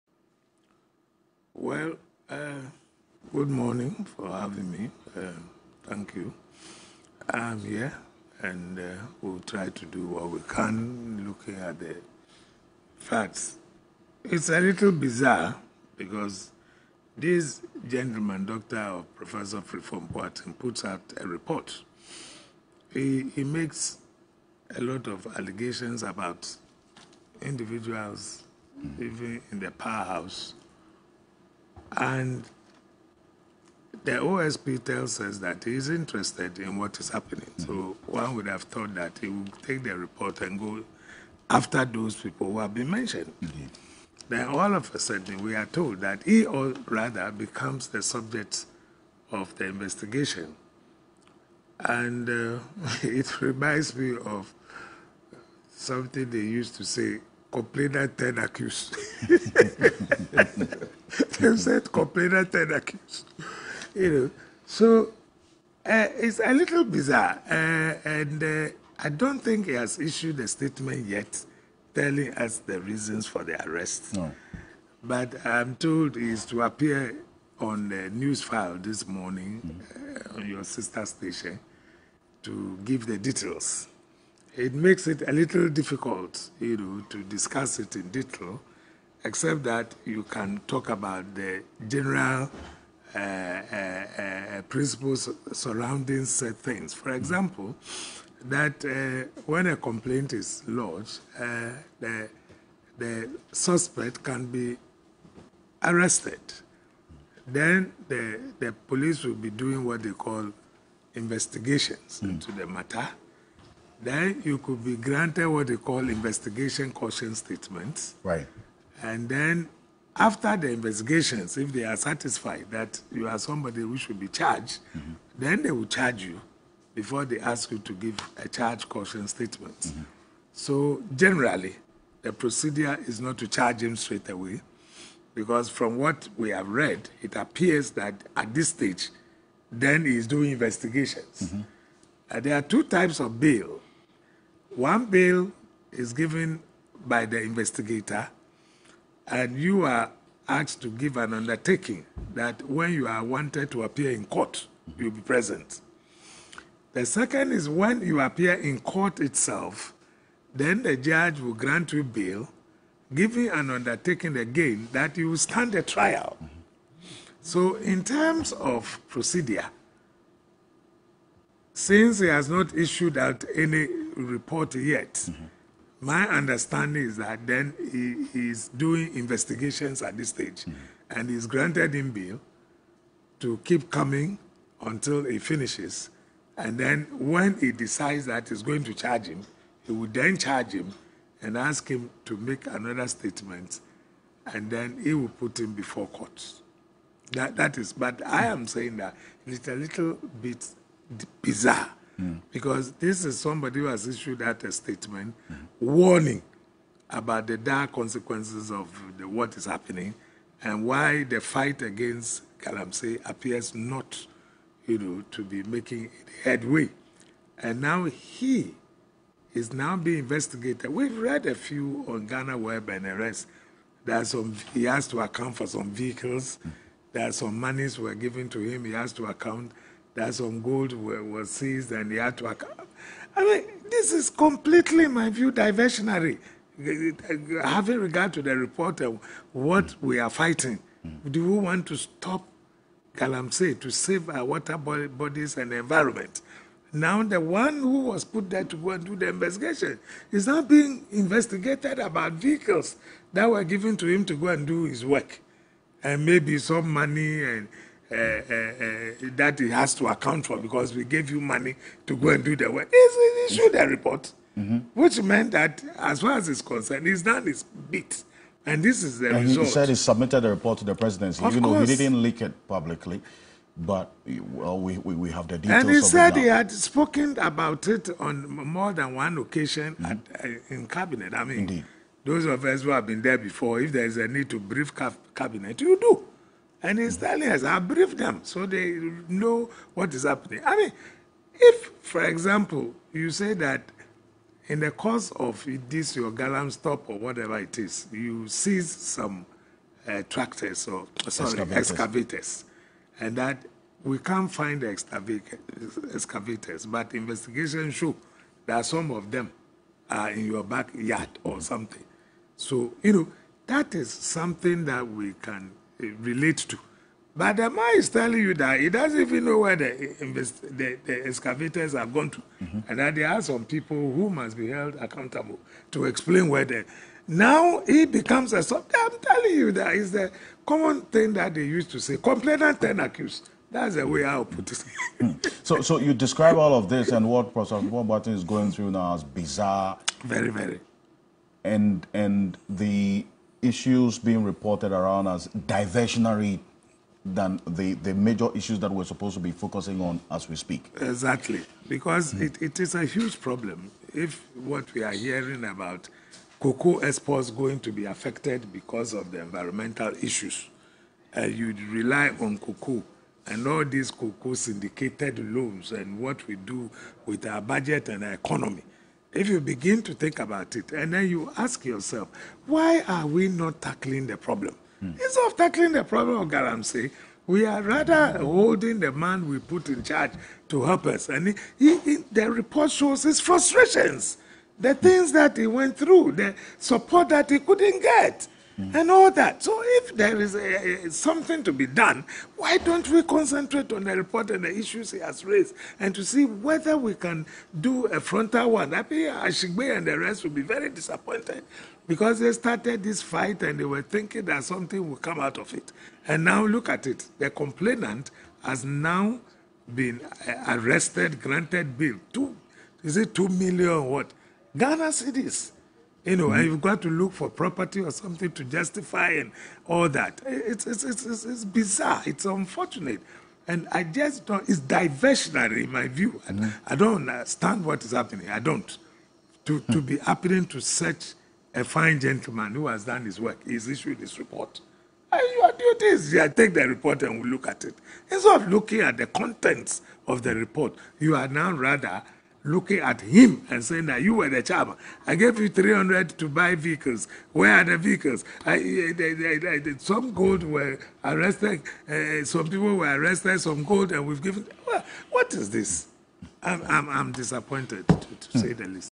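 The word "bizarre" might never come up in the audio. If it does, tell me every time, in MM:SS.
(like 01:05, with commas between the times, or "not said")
00:14, 01:06, 03:21, 05:39, 07:01.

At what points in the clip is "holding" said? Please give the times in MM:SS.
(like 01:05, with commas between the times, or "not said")
06:18.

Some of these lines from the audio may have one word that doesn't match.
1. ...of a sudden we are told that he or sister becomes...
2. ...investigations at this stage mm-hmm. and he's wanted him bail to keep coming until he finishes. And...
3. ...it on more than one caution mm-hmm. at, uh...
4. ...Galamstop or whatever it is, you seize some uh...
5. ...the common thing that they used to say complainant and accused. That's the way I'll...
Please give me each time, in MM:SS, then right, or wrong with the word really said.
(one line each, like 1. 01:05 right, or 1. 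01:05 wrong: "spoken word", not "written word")
1. 00:44 wrong: "rather", not "sister"
2. 02:59 wrong: "granted", not "wanted"
3. 04:37 wrong: "occasion", not "caution"
4. 04:56 right
5. 05:30 right.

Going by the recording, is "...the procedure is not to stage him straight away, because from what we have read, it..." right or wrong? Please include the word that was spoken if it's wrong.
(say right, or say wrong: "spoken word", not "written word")
wrong: "charge", not "stage".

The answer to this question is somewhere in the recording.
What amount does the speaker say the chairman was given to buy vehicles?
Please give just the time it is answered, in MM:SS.
07:25.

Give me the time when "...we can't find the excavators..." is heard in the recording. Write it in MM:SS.
05:04.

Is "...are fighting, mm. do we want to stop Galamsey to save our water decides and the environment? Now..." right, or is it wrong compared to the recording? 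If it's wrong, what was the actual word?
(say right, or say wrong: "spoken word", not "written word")
wrong: "bodies", not "decides".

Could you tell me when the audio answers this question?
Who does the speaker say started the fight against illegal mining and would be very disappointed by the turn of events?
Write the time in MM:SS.
06:39.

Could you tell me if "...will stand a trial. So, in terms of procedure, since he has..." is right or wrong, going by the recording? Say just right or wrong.
right.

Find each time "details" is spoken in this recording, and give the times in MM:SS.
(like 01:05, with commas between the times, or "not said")
01:23, 01:28, 04:35.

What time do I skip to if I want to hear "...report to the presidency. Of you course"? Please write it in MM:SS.
04:30.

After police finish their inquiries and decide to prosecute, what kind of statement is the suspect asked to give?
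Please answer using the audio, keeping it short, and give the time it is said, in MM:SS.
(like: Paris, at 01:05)
charge caution statement, at 02:08.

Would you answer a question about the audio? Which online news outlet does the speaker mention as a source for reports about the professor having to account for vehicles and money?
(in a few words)
Ghana Web.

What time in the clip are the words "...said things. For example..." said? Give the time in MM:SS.
01:36.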